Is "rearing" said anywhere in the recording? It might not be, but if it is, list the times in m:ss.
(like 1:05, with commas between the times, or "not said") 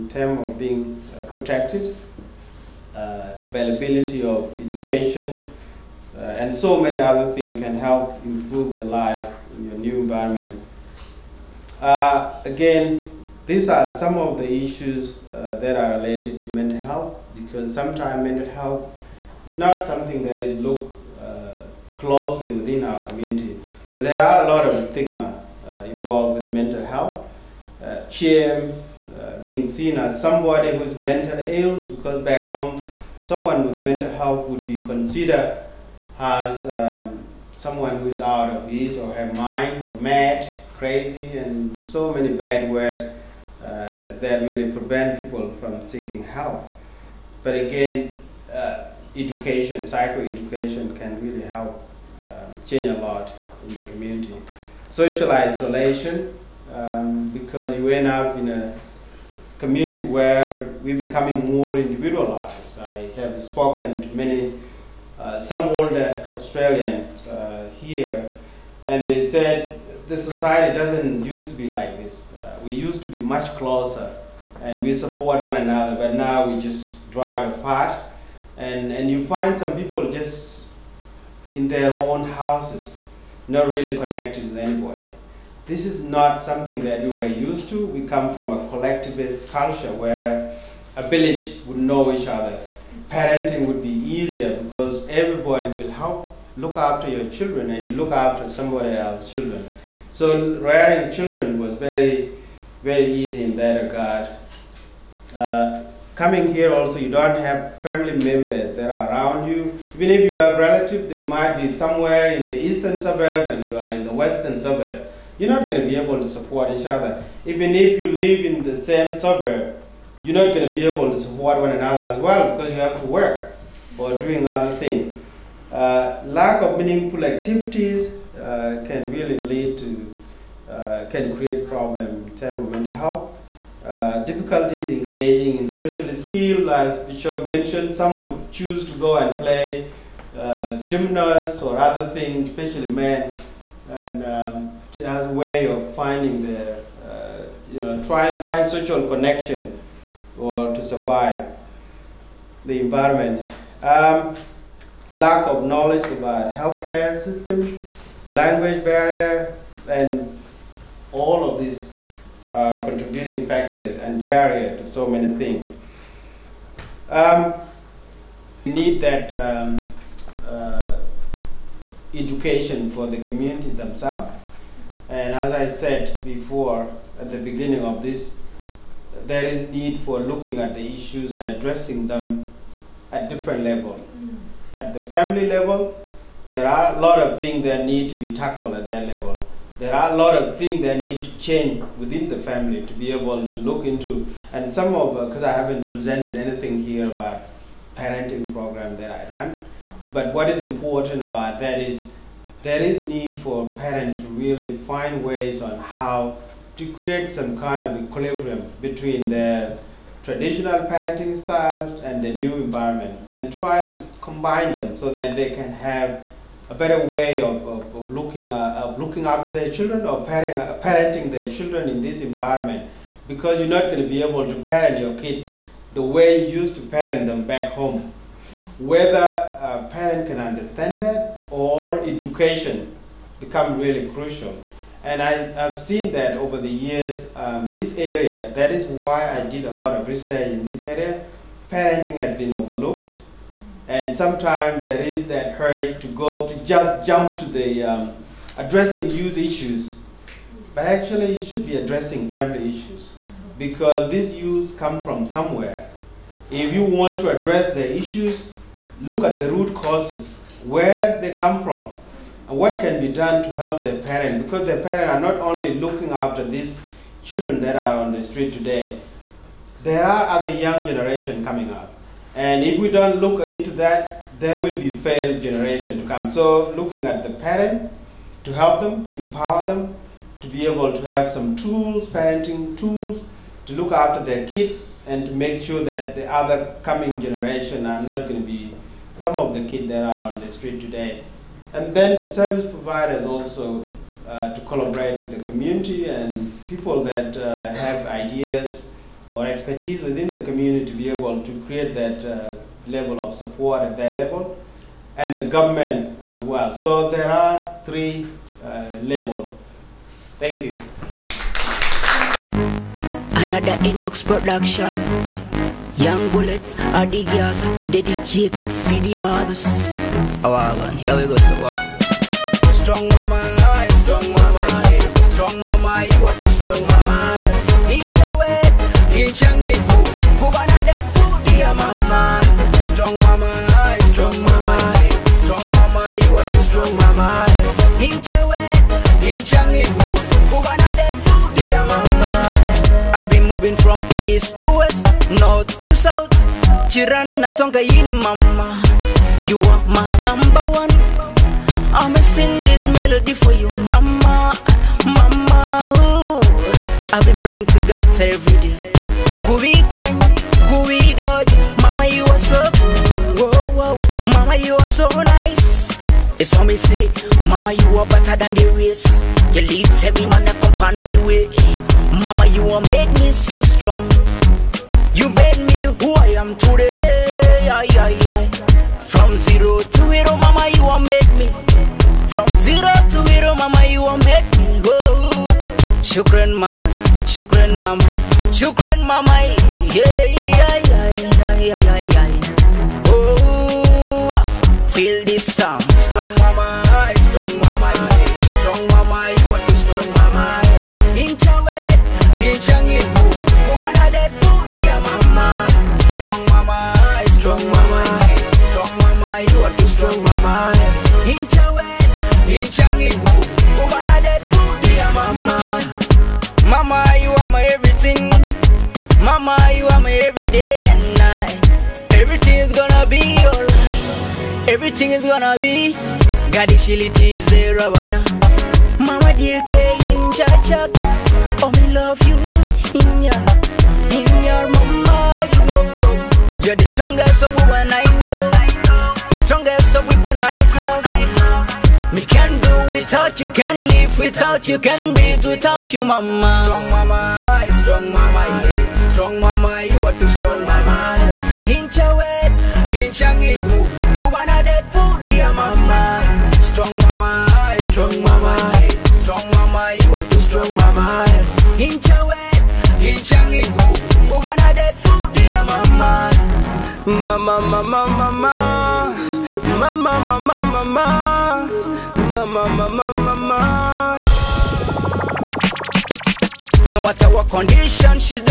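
1:40.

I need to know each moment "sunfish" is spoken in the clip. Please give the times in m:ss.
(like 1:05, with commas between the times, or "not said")
not said.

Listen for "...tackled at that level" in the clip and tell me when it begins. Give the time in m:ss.
3:08.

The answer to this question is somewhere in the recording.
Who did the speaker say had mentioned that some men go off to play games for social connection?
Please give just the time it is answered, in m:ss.
2:17.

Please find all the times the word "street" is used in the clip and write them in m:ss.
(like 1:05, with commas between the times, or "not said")
4:28, 4:50.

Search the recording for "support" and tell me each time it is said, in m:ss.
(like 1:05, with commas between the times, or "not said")
1:14, 1:56, 2:01, 5:03.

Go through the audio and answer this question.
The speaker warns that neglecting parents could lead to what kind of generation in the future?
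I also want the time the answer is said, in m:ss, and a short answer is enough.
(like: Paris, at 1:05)
failed generation, at 4:34.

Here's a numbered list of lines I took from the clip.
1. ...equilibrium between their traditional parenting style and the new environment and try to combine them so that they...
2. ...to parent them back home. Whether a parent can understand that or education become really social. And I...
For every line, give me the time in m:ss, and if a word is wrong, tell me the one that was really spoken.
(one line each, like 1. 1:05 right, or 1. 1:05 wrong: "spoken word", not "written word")
1. 3:28 right
2. 3:46 wrong: "crucial", not "social".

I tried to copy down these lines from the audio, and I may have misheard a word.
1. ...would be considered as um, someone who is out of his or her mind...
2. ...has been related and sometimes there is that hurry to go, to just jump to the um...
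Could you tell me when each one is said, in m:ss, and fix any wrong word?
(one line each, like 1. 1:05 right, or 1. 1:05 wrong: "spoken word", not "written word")
1. 0:34 right
2. 4:02 wrong: "overlooked", not "related".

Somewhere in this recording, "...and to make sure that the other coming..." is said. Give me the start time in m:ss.
4:45.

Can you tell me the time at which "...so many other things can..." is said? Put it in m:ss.
0:06.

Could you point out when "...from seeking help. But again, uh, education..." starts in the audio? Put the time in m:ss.
0:45.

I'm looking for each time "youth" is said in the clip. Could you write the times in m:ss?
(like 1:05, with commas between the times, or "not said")
4:09, 4:14.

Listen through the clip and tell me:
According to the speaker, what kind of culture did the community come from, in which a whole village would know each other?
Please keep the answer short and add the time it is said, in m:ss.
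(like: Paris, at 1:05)
collectivist culture, at 1:28.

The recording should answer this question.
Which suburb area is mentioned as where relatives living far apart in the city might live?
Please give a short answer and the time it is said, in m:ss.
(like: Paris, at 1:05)
eastern suburb, at 1:52.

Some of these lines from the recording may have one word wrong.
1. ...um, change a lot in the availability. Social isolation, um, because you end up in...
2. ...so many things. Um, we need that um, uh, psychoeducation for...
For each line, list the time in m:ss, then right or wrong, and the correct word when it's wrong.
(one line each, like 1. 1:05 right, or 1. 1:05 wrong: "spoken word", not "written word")
1. 0:52 wrong: "community", not "availability"
2. 2:44 wrong: "education", not "psychoeducation".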